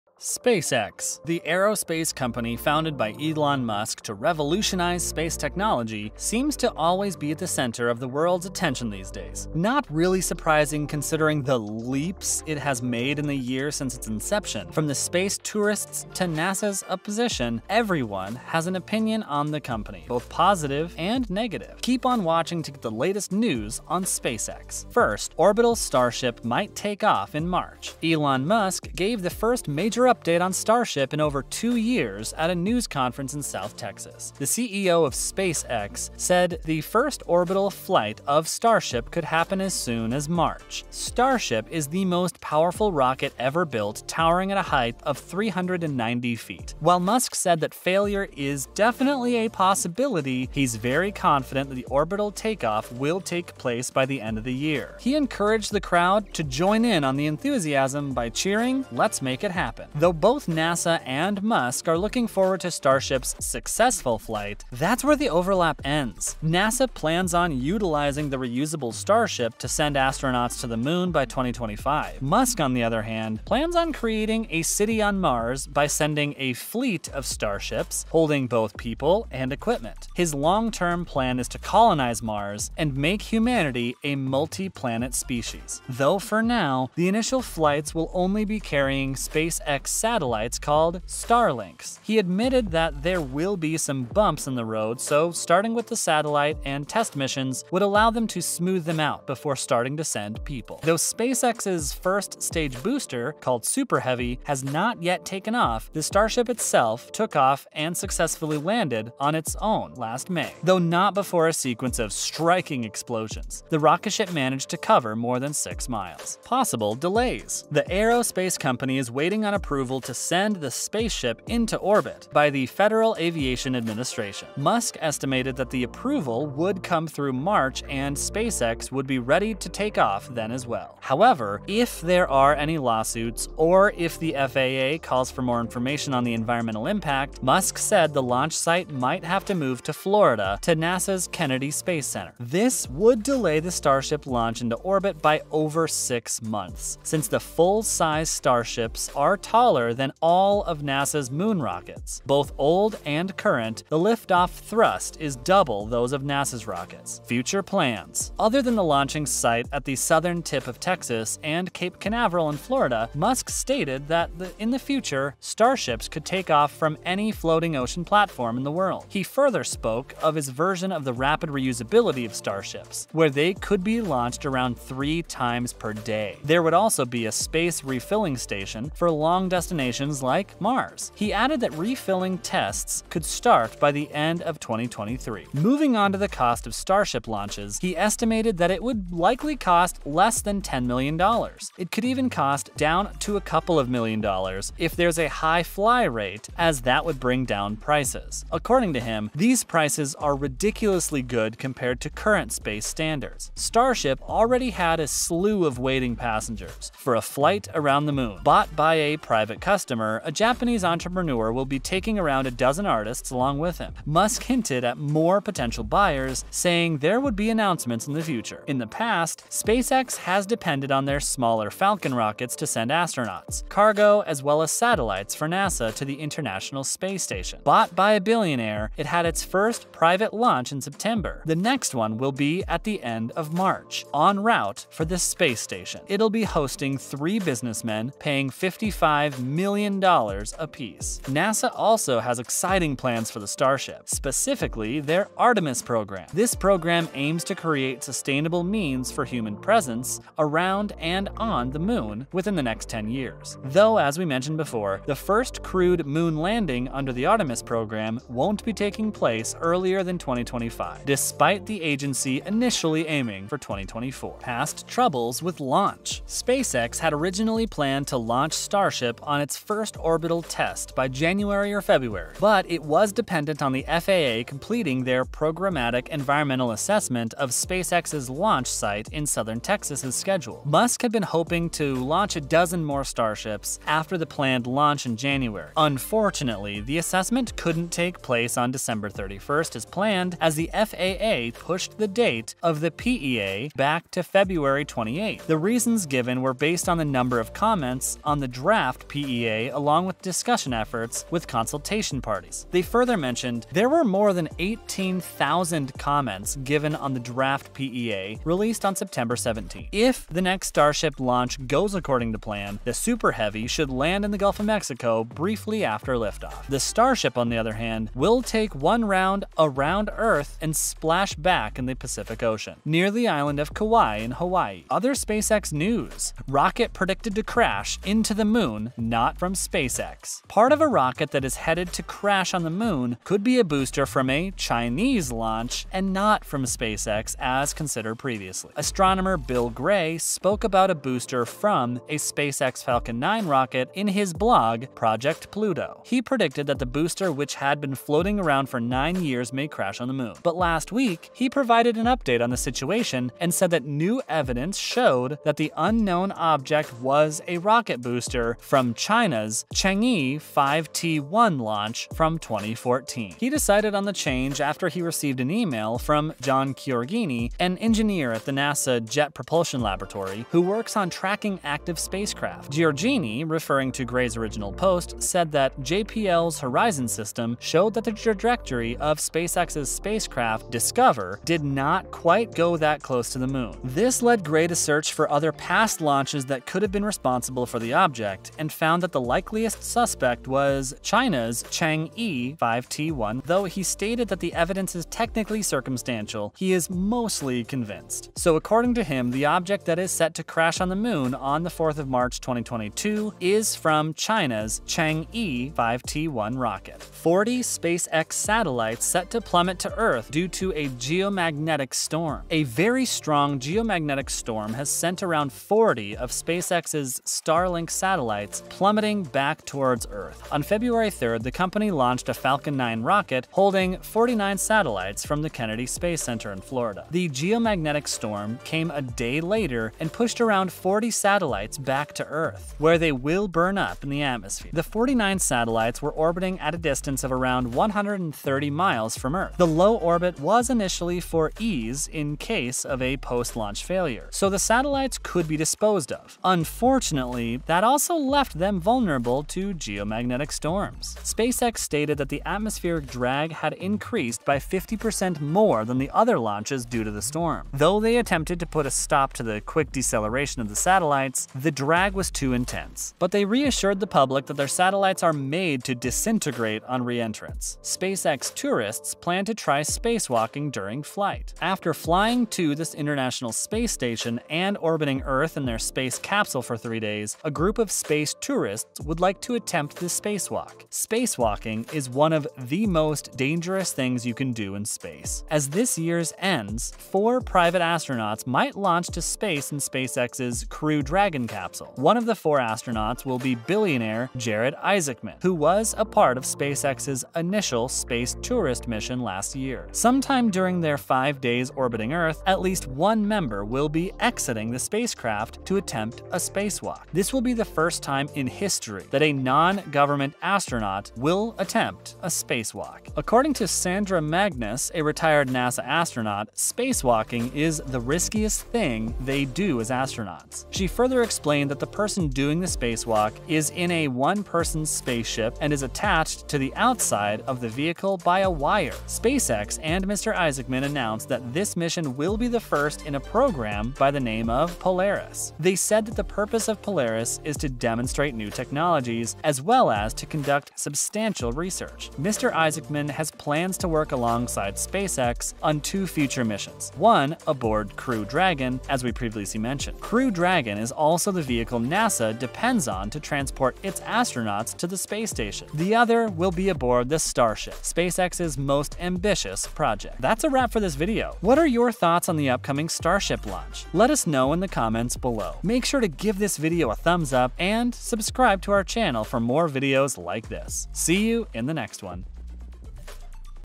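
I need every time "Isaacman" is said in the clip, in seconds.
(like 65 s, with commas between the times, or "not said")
494 s, 530 s, 542 s.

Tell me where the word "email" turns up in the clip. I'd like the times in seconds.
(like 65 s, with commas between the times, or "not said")
365 s.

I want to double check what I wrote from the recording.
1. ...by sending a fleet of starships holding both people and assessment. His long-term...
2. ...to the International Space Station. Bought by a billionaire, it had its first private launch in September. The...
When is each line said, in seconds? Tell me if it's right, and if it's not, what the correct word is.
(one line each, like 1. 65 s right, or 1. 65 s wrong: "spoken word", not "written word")
1. 75 s wrong: "equipment", not "assessment"
2. 225 s right.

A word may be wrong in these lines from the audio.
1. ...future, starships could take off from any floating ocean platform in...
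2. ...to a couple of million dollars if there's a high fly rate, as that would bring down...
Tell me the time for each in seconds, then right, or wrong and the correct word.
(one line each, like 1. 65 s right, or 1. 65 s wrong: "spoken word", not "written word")
1. 164 s right
2. 193 s right.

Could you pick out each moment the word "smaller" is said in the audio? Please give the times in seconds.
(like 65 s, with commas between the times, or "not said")
221 s.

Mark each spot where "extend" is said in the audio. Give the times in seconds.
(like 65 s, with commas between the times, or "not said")
not said.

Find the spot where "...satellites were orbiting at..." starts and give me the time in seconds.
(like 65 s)
435 s.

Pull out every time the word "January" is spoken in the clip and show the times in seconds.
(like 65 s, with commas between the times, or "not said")
271 s, 285 s.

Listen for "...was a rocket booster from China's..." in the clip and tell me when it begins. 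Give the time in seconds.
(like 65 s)
356 s.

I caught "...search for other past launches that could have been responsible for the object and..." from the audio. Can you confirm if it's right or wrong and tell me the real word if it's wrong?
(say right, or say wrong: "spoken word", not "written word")
right.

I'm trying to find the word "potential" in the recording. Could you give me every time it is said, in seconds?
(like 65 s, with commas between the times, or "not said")
215 s.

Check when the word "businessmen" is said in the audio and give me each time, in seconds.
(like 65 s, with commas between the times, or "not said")
237 s.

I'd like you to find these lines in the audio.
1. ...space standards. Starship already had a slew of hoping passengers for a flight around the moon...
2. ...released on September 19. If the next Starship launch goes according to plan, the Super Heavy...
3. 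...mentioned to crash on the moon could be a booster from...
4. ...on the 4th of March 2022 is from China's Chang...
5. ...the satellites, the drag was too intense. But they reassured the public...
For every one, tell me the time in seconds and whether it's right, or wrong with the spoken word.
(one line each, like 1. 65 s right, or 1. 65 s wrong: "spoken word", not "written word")
1. 202 s wrong: "waiting", not "hoping"
2. 308 s wrong: "17", not "19"
3. 331 s wrong: "headed", not "mentioned"
4. 401 s right
5. 460 s right.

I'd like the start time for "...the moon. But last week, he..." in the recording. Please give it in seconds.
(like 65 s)
350 s.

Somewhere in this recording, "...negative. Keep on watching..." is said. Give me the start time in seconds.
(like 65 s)
21 s.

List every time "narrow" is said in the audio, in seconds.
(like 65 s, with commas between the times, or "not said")
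not said.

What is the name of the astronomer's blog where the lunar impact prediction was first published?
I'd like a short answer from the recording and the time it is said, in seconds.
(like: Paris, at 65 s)
Project Pluto, at 344 s.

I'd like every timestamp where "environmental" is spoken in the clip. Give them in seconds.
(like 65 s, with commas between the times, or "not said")
136 s, 276 s.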